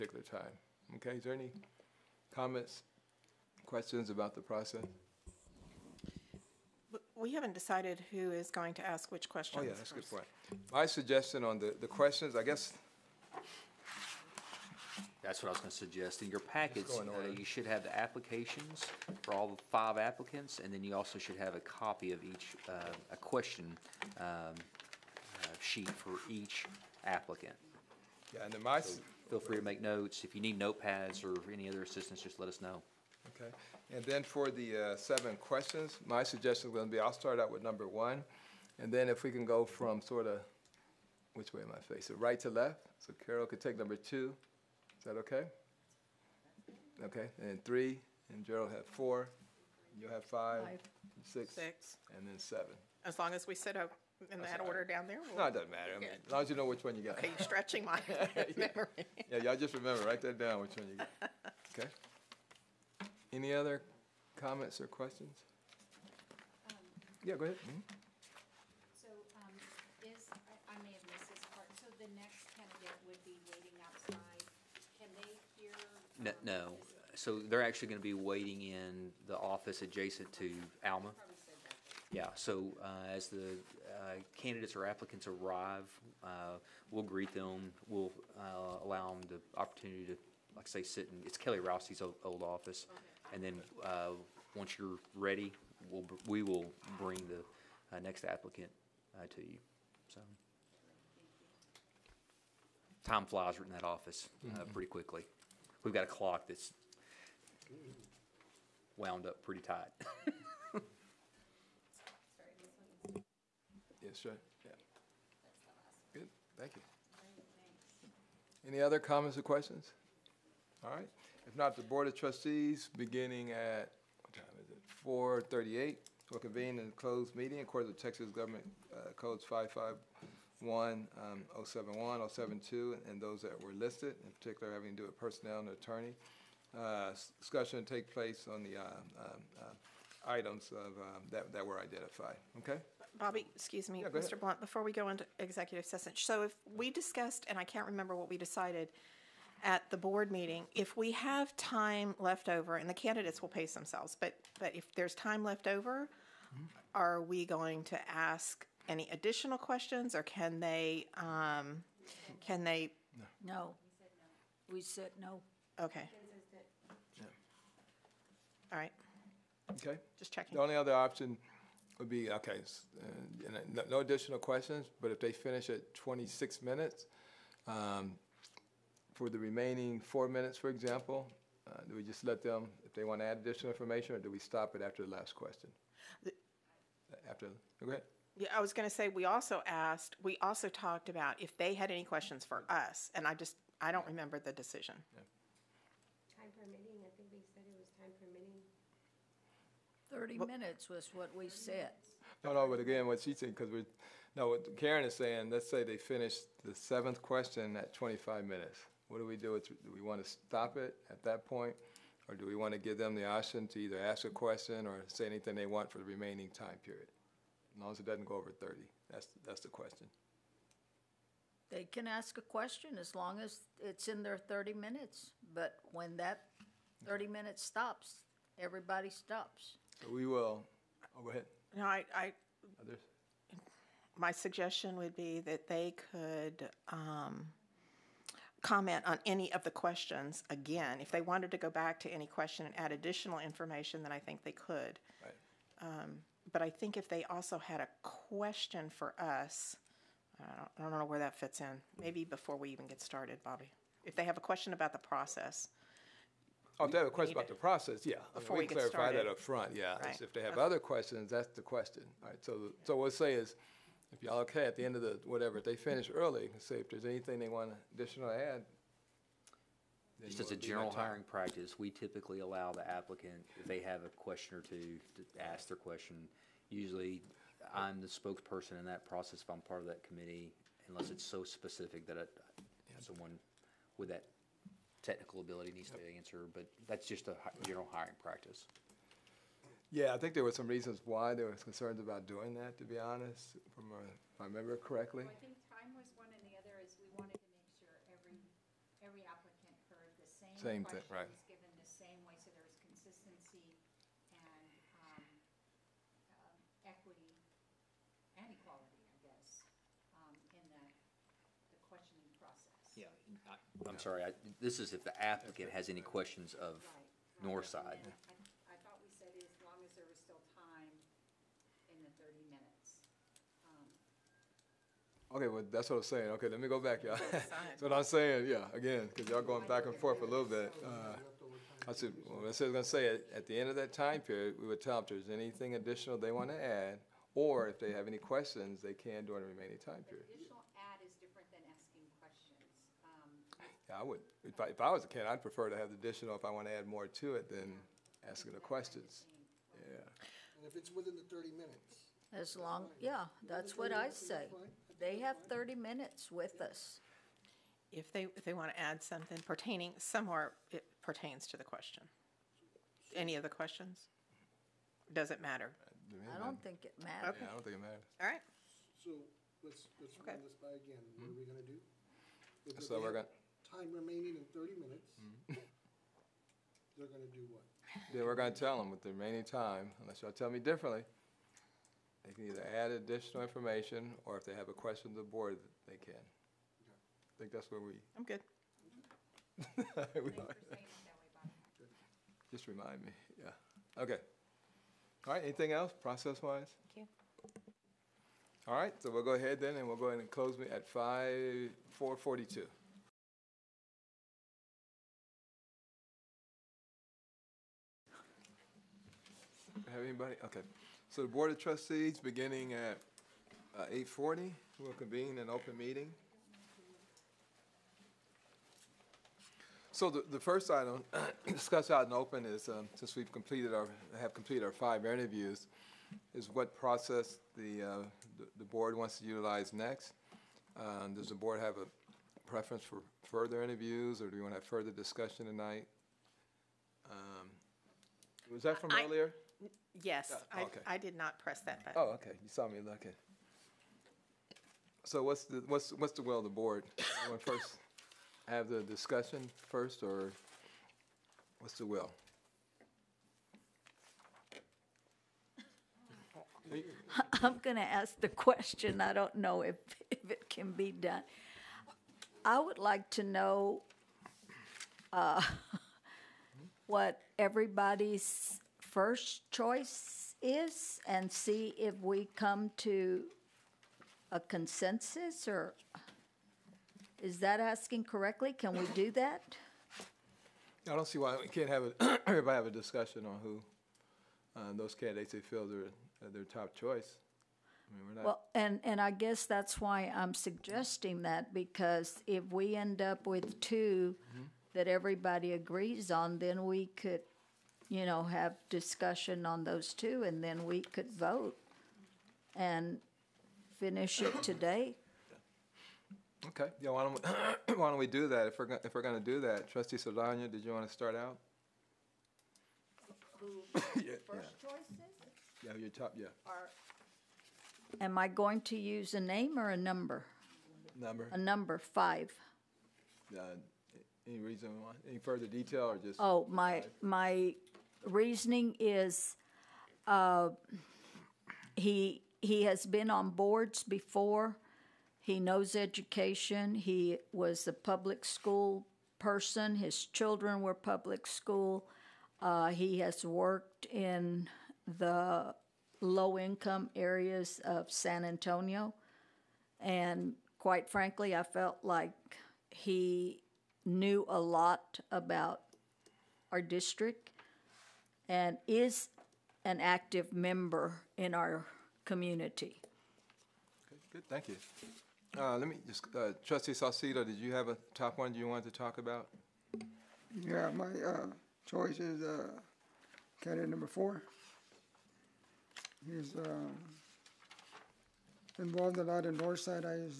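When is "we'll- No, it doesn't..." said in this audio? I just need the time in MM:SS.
00:55.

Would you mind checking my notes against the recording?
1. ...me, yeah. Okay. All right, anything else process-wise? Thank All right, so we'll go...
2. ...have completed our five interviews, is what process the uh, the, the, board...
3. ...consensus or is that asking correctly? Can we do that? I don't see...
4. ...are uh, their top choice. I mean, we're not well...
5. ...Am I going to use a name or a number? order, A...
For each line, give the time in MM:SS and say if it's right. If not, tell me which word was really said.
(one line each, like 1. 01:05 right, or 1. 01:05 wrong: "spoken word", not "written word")
1. 06:33 right
2. 07:04 right
3. 07:54 right
4. 08:05 right
5. 08:38 wrong: "number", not "order".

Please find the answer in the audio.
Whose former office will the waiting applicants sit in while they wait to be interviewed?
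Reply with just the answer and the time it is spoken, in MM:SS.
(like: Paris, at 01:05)
Kelly Rousey, at 01:31.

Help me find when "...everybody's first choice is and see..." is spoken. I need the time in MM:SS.
07:47.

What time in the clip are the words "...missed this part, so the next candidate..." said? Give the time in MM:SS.
01:11.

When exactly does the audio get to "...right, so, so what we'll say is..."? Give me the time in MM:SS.
04:22.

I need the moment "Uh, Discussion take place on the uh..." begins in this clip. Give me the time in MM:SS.
02:16.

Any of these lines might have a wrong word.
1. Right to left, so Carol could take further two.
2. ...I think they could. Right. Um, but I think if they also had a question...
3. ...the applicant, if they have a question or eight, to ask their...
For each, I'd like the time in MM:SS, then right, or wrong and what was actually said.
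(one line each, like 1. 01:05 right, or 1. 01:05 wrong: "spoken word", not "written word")
1. 00:42 wrong: "number", not "further"
2. 04:04 right
3. 04:32 wrong: "two", not "eight".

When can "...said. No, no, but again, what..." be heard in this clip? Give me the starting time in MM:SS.
03:21.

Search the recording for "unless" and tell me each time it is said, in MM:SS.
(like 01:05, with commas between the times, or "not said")
04:40, 06:20.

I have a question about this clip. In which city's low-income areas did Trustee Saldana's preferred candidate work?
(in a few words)
San Antonio.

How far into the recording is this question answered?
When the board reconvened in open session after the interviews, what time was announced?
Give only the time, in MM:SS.
06:53.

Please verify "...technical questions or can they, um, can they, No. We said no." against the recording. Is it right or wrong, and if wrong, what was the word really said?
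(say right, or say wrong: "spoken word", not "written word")
wrong: "additional", not "technical".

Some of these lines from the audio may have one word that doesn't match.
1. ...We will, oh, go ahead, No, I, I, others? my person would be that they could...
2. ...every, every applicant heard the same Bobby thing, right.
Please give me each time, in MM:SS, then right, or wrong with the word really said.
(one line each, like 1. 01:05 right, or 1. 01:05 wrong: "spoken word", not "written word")
1. 03:50 wrong: "suggestion", not "person"
2. 04:58 wrong: "Same", not "Bobby".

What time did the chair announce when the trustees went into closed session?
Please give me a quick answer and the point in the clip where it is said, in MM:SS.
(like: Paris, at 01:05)
4:38, at 02:05.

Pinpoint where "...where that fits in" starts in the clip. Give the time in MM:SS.
04:11.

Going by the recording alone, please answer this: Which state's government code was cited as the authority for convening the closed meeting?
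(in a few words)
Texas.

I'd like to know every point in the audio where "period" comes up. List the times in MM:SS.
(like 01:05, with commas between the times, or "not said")
03:36, 05:34, 05:40.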